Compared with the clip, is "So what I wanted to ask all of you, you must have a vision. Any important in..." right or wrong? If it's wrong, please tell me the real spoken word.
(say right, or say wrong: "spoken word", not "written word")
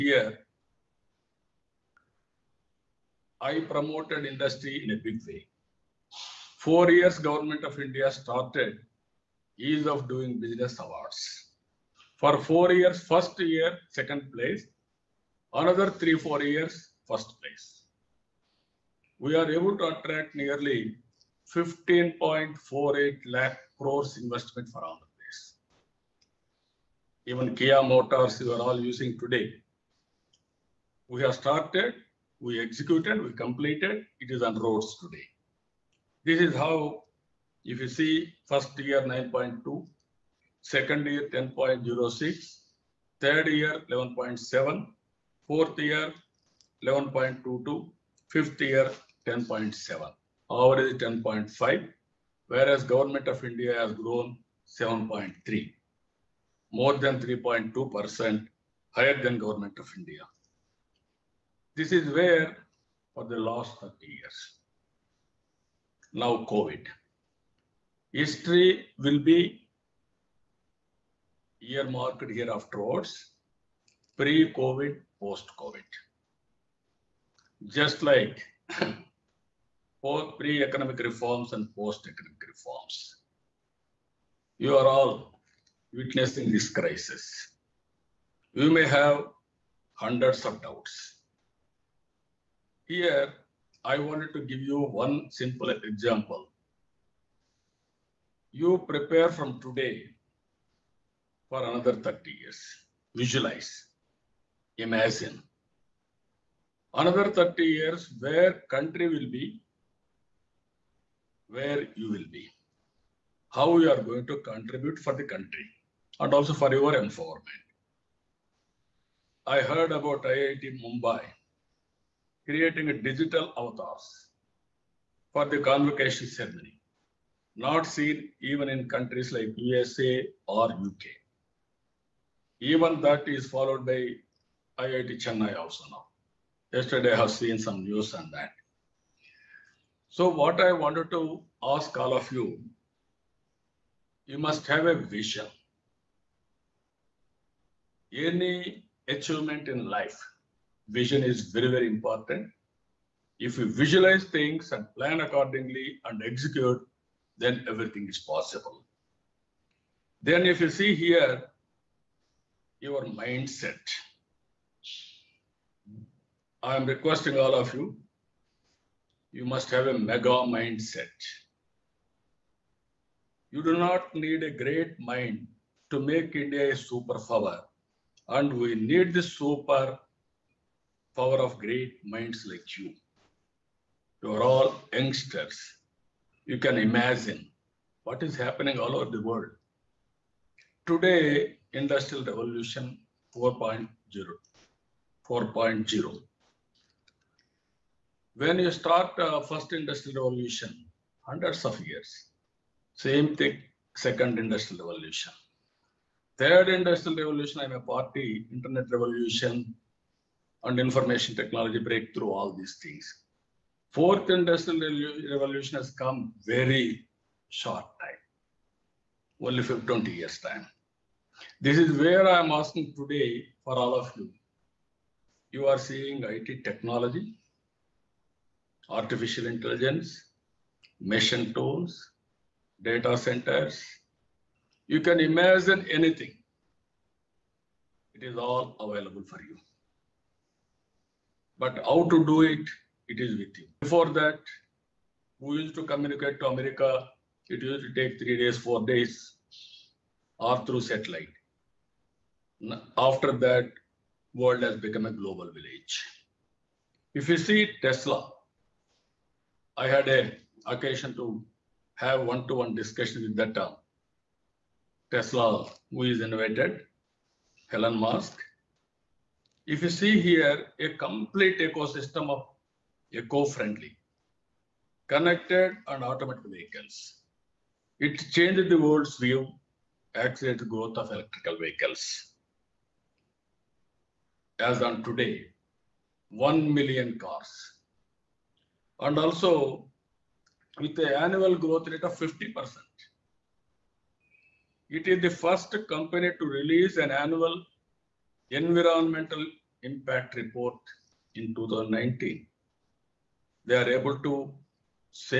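wrong: "achievement", not "important".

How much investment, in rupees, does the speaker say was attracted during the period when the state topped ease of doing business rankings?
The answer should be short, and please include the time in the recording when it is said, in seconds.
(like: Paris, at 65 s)
15.48 lakh crores, at 21 s.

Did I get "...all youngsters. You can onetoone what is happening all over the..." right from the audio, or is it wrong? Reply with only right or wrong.
wrong.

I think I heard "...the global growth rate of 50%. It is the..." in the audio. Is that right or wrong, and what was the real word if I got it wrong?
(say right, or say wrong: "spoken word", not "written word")
wrong: "annual", not "global".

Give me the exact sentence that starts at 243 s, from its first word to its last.
Before that, who used to communicate to America, it used to take three days, four days, or through satellite.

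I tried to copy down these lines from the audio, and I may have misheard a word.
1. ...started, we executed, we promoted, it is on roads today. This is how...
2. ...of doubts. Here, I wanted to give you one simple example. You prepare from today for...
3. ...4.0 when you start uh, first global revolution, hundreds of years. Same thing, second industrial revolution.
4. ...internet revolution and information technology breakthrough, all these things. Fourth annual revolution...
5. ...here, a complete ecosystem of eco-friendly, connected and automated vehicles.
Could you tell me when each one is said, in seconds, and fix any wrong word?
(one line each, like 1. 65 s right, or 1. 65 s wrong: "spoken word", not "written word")
1. 31 s wrong: "completed", not "promoted"
2. 90 s right
3. 195 s wrong: "industrial", not "global"
4. 208 s wrong: "industrial", not "annual"
5. 270 s right.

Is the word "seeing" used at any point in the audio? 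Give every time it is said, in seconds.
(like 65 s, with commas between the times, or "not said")
225 s.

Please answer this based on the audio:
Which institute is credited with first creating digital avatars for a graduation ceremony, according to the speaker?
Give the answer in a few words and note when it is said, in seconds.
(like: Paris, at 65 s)
IIT Mumbai, at 120 s.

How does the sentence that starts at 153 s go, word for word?
If you visualize things and plan accordingly and execute, then everything is possible.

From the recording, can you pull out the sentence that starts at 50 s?
Our is 10.5, whereas government of India has grown 7.3, more than 3.2% higher than government of India.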